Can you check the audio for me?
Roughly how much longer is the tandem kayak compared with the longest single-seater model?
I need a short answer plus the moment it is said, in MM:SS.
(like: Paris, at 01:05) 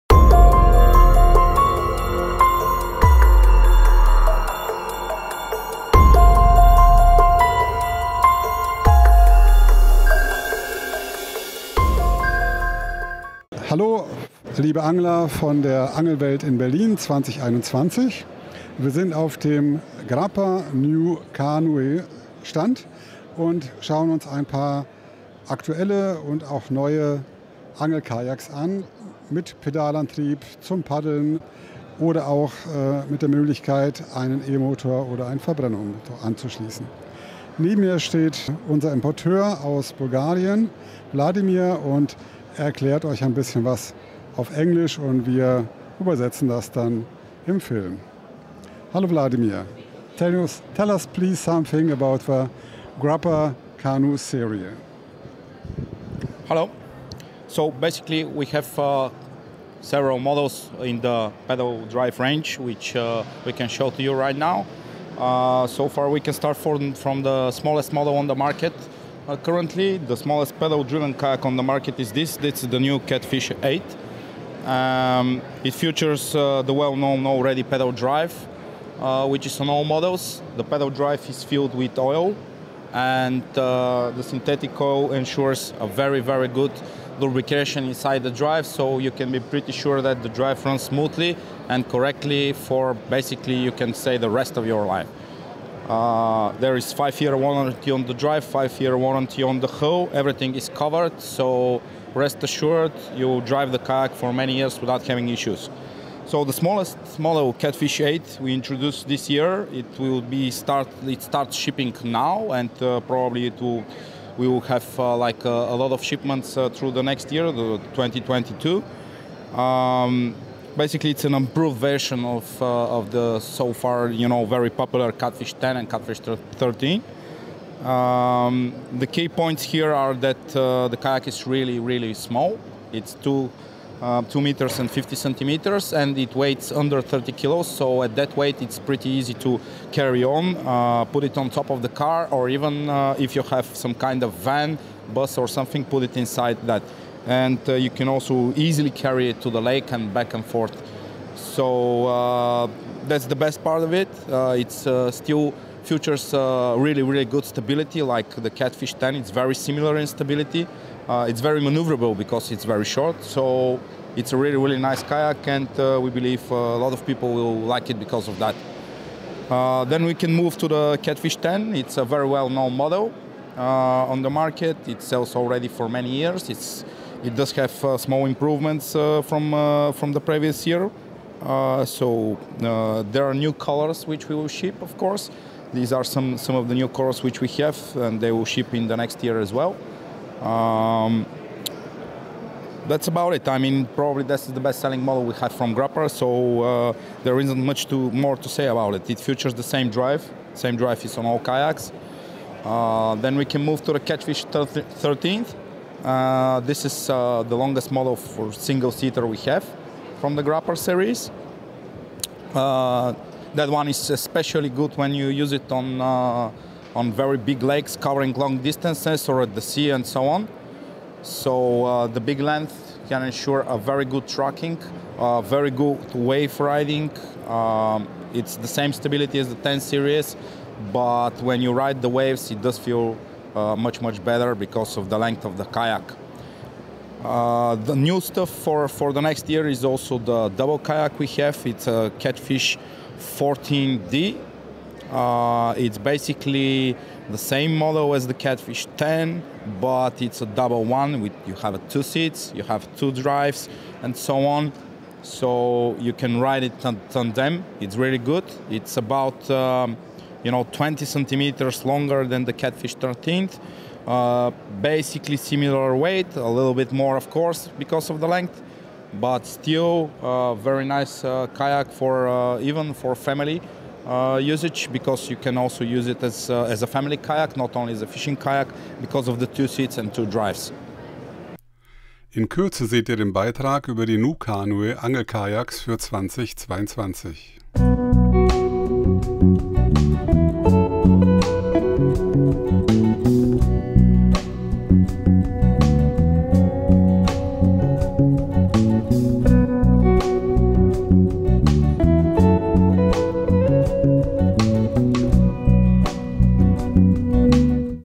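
20 centimeters, at 04:20.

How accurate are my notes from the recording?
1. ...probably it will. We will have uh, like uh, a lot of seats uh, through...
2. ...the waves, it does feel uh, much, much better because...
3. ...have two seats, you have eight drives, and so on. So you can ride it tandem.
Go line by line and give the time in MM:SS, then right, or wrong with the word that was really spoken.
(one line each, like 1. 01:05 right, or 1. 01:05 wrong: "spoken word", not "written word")
1. 01:53 wrong: "shipments", not "seats"
2. 03:52 right
3. 04:11 wrong: "two", not "eight".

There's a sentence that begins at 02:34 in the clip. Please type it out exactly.
Uh, it's uh, still features uh, really, really good stability, like the Catfish 10.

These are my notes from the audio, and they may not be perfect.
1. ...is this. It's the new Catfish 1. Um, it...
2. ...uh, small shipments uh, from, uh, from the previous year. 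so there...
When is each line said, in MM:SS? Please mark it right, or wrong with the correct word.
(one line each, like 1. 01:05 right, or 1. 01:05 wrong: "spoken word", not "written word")
1. 01:12 wrong: "8", not "1"
2. 02:57 wrong: "improvements", not "shipments".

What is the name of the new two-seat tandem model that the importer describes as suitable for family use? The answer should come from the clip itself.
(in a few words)
Catfish 14D.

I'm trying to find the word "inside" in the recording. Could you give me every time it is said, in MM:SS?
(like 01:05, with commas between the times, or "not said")
01:27, 02:26.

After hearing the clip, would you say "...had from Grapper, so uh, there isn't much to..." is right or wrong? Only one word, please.
right.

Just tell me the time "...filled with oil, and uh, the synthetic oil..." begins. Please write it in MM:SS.
01:21.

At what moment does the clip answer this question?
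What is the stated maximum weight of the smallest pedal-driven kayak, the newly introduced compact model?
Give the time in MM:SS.
02:16.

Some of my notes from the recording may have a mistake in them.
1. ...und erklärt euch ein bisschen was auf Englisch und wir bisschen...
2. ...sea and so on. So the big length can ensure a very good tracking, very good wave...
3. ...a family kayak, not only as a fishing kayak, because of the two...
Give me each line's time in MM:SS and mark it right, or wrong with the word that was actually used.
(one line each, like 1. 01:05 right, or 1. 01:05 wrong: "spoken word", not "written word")
1. 00:41 wrong: "übersetzen", not "bisschen"
2. 03:39 right
3. 04:36 right.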